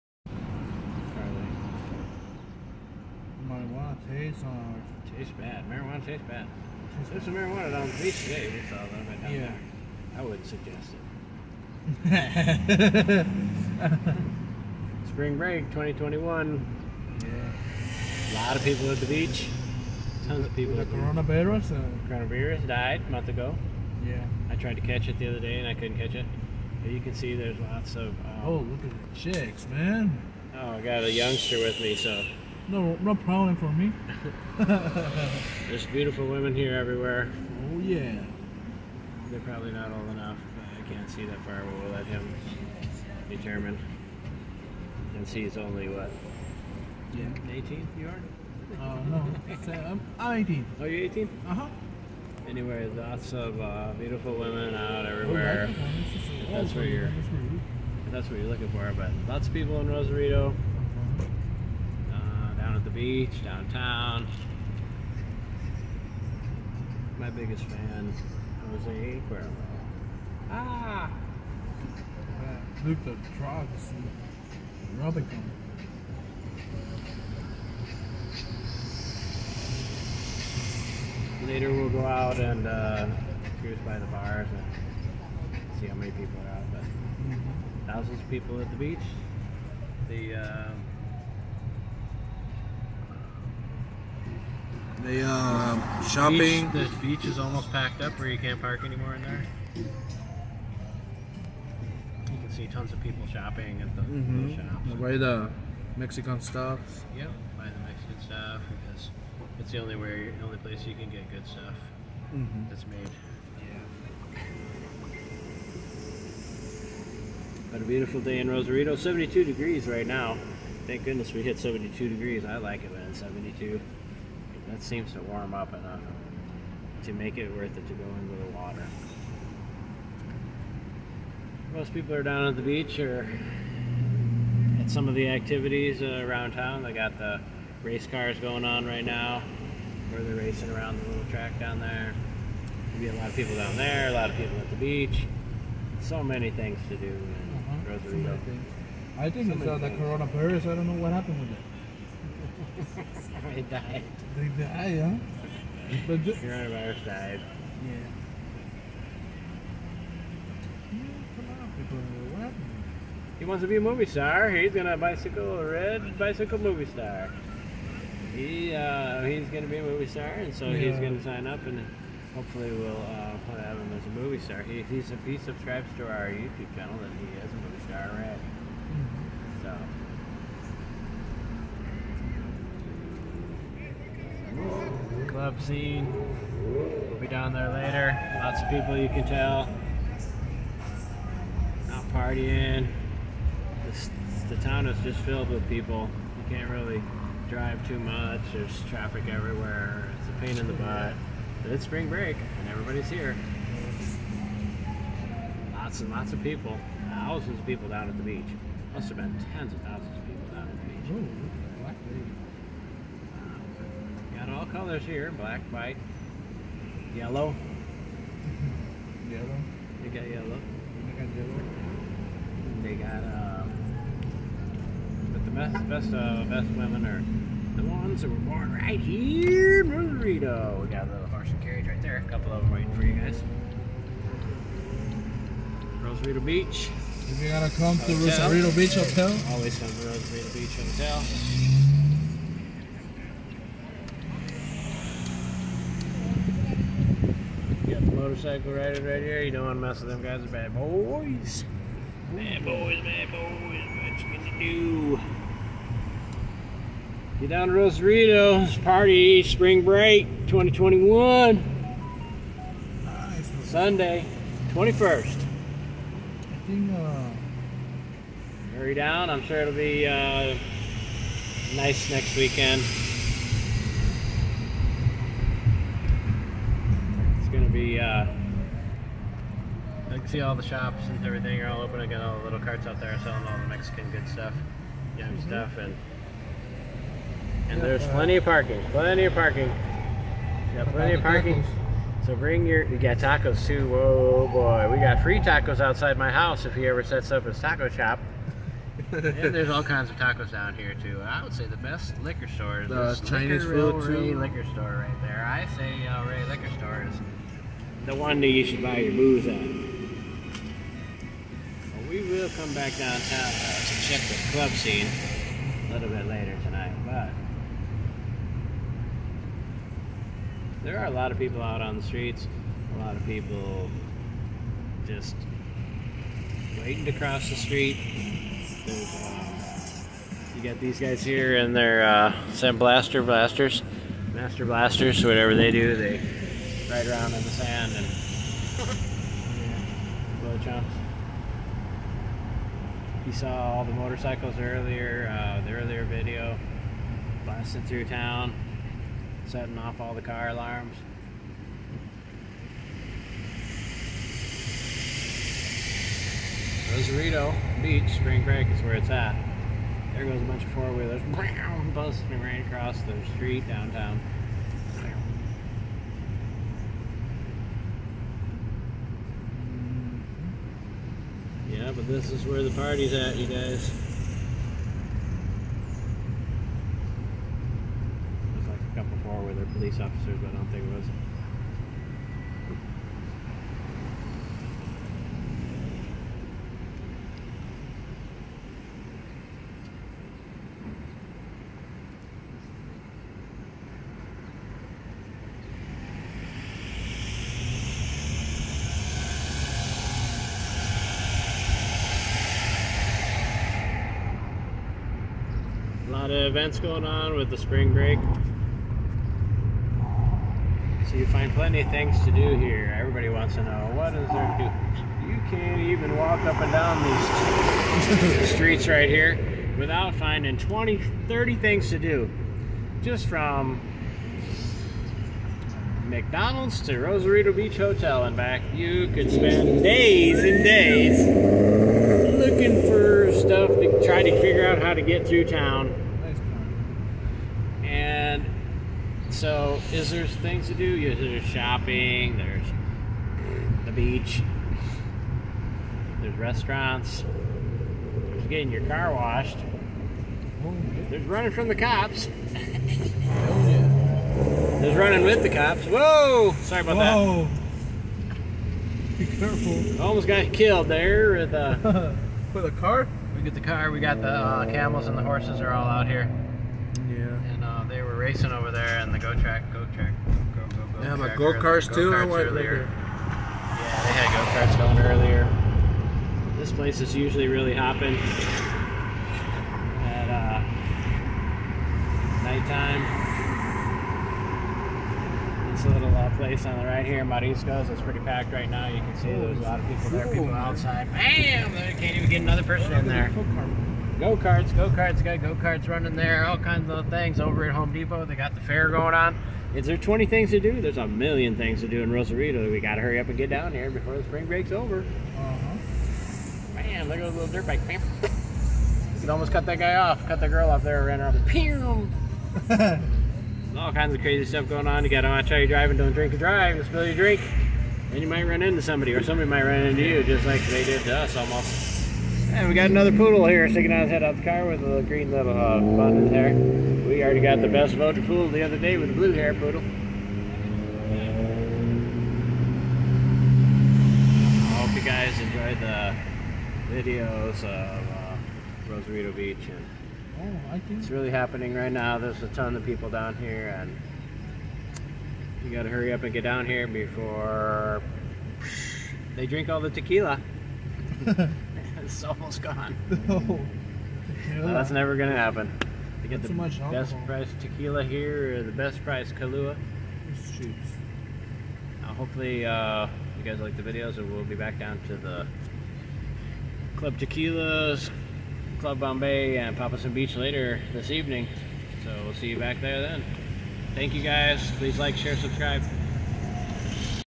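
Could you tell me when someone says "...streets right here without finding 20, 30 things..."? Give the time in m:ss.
6:58.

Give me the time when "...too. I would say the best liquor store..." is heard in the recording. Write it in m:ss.
5:01.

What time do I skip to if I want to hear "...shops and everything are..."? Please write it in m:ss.
4:40.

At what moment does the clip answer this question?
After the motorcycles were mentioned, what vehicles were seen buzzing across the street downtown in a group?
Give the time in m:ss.
6:00.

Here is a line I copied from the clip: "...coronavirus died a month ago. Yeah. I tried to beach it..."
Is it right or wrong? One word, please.
wrong.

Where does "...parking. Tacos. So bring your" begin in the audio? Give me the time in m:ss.
4:51.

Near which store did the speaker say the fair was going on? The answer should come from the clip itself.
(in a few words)
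Home Depot.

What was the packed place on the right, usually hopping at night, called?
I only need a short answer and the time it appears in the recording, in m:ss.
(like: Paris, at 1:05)
Mariscos, at 8:07.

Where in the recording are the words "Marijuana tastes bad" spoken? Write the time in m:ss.
0:05.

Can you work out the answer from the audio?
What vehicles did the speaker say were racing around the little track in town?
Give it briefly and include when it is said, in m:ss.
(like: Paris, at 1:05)
Race cars, at 2:17.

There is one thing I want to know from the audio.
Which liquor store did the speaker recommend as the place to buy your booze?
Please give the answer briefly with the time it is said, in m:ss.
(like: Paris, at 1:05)
El Rey, at 5:06.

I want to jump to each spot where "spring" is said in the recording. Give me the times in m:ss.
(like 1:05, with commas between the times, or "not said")
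0:15, 3:21, 4:19, 5:58, 6:47, 8:24.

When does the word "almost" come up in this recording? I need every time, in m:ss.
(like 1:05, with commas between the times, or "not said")
1:37, 7:40, 8:29, 8:41, 9:12.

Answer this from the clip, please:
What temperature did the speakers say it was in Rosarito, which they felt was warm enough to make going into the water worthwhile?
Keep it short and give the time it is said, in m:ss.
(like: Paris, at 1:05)
72 degrees, at 1:58.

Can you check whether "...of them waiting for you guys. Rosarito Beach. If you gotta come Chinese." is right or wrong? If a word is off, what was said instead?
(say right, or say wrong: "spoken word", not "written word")
wrong: "Hotel", not "Chinese".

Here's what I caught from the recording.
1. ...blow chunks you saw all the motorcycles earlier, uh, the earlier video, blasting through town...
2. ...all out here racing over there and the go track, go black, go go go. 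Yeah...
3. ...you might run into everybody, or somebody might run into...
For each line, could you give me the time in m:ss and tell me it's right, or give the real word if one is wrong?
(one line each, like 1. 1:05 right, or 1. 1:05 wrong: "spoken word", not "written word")
1. 5:40 right
2. 7:45 wrong: "track", not "black"
3. 8:38 wrong: "somebody", not "everybody".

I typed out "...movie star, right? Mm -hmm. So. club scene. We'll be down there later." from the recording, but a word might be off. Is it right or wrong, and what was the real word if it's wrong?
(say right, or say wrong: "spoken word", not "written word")
right.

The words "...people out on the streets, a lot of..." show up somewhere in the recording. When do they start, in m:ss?
5:21.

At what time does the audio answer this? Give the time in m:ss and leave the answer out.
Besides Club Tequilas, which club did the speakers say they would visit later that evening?
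9:28.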